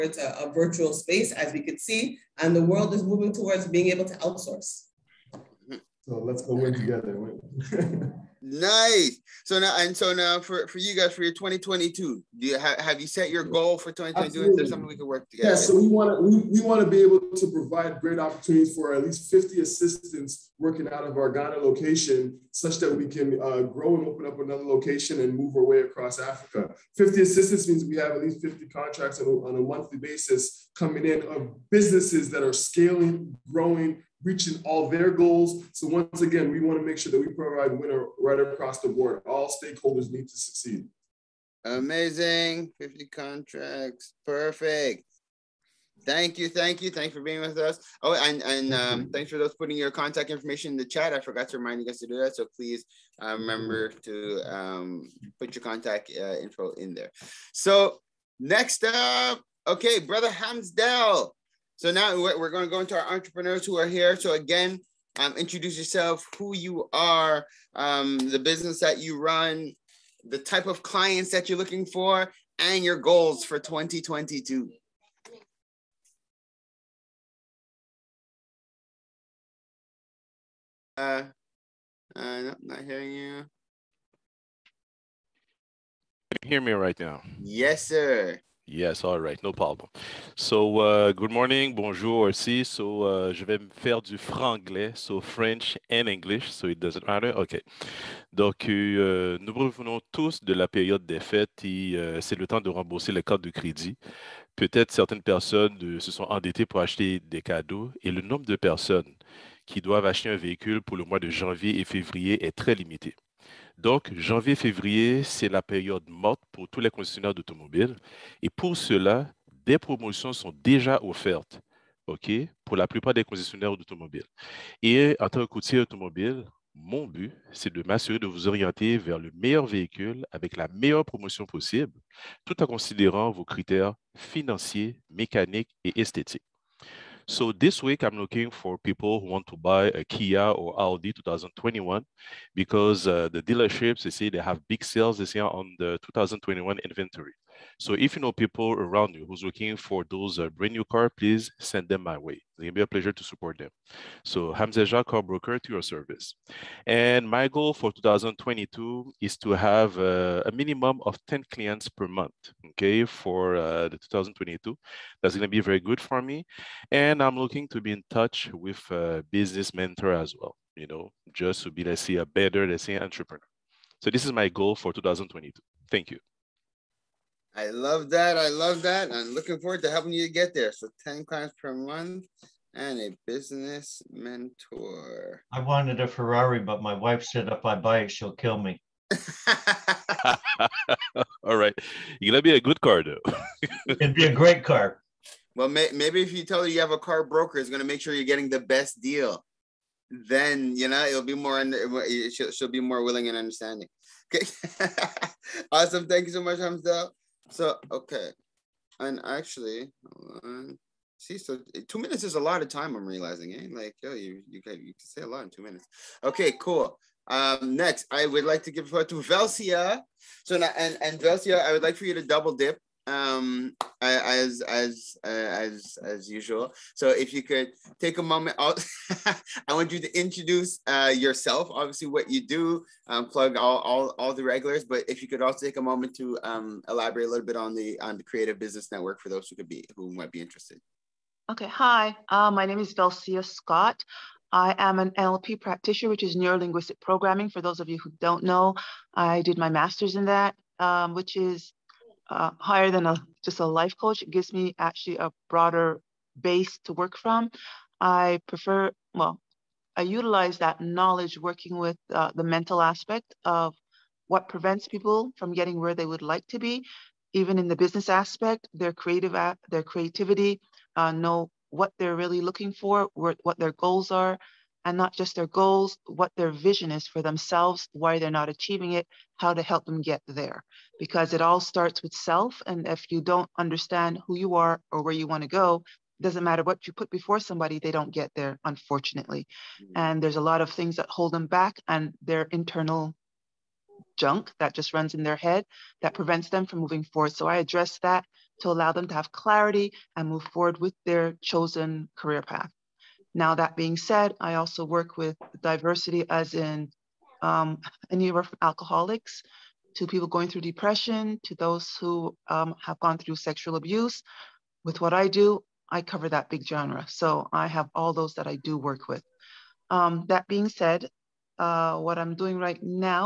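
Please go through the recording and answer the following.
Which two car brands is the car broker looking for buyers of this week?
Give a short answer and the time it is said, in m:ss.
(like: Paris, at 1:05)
Kia or Audi, at 2:20.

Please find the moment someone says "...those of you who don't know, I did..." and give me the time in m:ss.
4:07.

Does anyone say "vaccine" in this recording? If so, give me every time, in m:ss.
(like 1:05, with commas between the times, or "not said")
not said.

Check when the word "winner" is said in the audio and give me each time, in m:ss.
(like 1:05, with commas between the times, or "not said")
0:37.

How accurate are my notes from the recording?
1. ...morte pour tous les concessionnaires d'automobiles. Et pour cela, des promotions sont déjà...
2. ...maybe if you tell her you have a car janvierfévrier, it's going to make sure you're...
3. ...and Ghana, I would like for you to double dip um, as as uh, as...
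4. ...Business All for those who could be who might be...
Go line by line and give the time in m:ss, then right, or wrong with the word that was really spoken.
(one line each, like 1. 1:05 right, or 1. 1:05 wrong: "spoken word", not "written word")
1. 1:56 right
2. 3:15 wrong: "broker", not "janvierfévrier"
3. 3:40 wrong: "Velsia", not "Ghana"
4. 3:58 wrong: "Network", not "All".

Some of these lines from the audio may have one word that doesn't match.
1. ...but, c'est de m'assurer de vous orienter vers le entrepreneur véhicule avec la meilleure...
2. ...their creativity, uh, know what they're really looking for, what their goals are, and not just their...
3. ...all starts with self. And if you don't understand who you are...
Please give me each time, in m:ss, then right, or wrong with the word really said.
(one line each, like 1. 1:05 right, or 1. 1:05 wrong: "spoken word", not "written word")
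1. 2:07 wrong: "meilleur", not "entrepreneur"
2. 4:29 right
3. 4:41 right.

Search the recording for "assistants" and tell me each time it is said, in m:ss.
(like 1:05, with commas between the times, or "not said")
0:19, 0:27.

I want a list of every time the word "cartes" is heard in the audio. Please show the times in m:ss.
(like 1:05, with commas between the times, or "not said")
1:43.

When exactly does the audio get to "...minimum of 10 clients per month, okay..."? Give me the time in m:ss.
2:40.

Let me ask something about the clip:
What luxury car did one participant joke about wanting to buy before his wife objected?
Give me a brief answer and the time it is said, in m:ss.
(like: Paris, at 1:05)
Ferrari, at 3:06.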